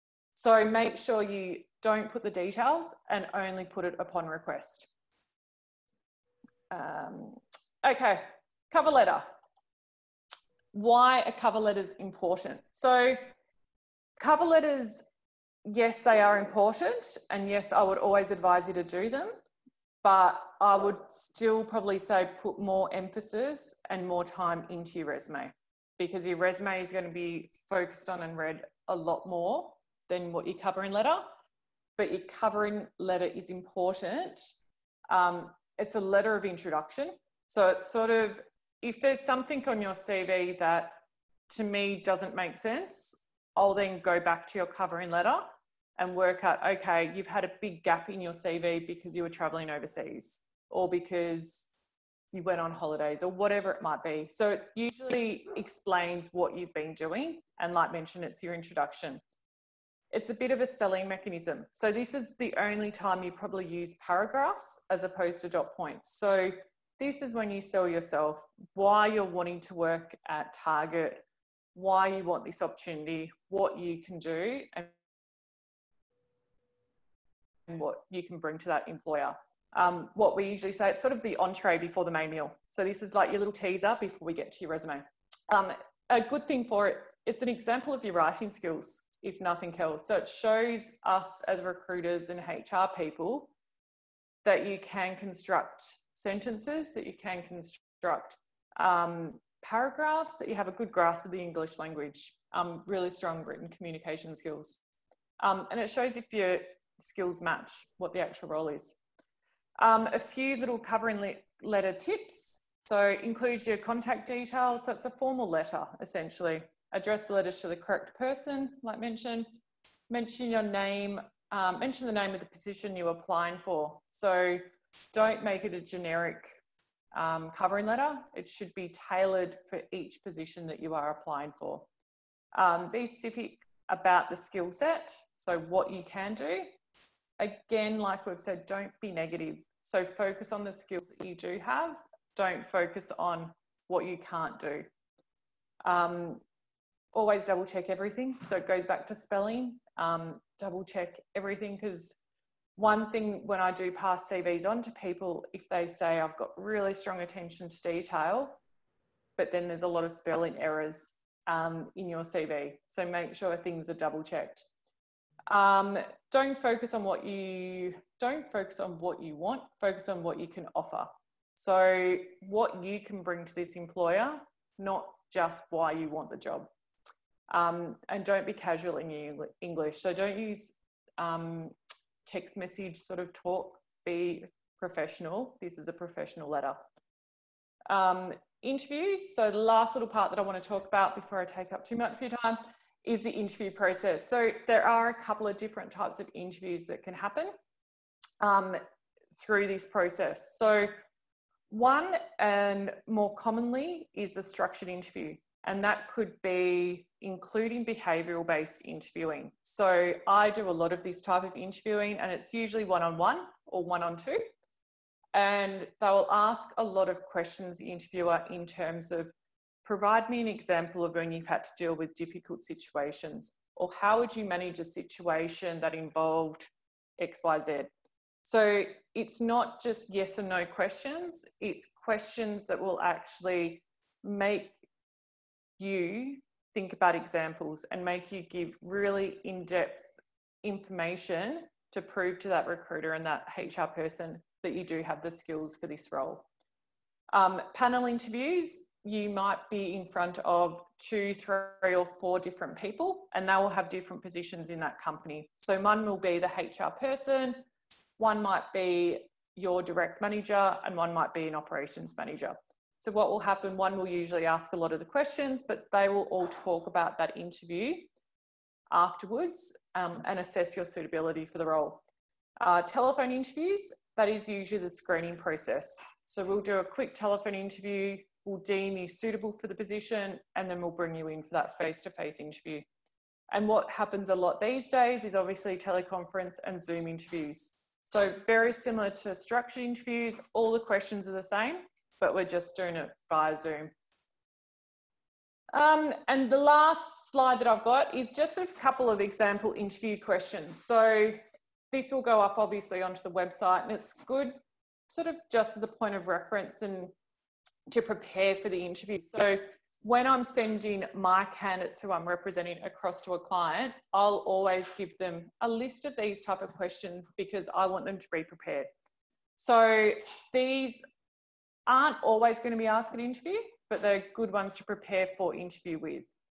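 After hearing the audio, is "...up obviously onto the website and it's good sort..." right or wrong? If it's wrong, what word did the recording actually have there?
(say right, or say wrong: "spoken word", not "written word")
right.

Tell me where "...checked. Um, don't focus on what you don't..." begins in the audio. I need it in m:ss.
2:44.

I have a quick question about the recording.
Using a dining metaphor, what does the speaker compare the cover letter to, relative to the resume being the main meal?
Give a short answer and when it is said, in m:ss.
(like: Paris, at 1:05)
the entree, at 1:21.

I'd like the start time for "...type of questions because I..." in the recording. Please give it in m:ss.
5:16.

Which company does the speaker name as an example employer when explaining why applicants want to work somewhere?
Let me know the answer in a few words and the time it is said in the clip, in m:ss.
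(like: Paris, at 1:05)
Target, at 1:10.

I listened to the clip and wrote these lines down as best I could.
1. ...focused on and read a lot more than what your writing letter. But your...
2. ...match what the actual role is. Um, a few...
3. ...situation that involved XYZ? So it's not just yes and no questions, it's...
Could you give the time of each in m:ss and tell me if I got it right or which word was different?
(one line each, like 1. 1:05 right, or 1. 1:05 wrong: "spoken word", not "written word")
1. 0:27 wrong: "covering", not "writing"
2. 1:47 right
3. 3:44 right.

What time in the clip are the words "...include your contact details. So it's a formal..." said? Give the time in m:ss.
1:53.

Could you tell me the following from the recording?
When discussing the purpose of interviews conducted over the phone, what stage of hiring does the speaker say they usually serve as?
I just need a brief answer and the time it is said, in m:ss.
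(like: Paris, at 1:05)
screening process, at 4:34.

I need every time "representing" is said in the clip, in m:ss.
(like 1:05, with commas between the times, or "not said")
5:12.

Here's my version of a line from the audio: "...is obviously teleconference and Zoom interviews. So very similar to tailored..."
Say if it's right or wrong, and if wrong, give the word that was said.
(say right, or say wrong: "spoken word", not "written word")
wrong: "structured", not "tailored".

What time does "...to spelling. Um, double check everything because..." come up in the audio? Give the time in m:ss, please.
2:29.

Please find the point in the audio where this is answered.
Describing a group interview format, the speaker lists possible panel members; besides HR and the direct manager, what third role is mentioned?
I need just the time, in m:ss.
4:21.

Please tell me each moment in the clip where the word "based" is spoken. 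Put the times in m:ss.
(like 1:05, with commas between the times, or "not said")
3:28.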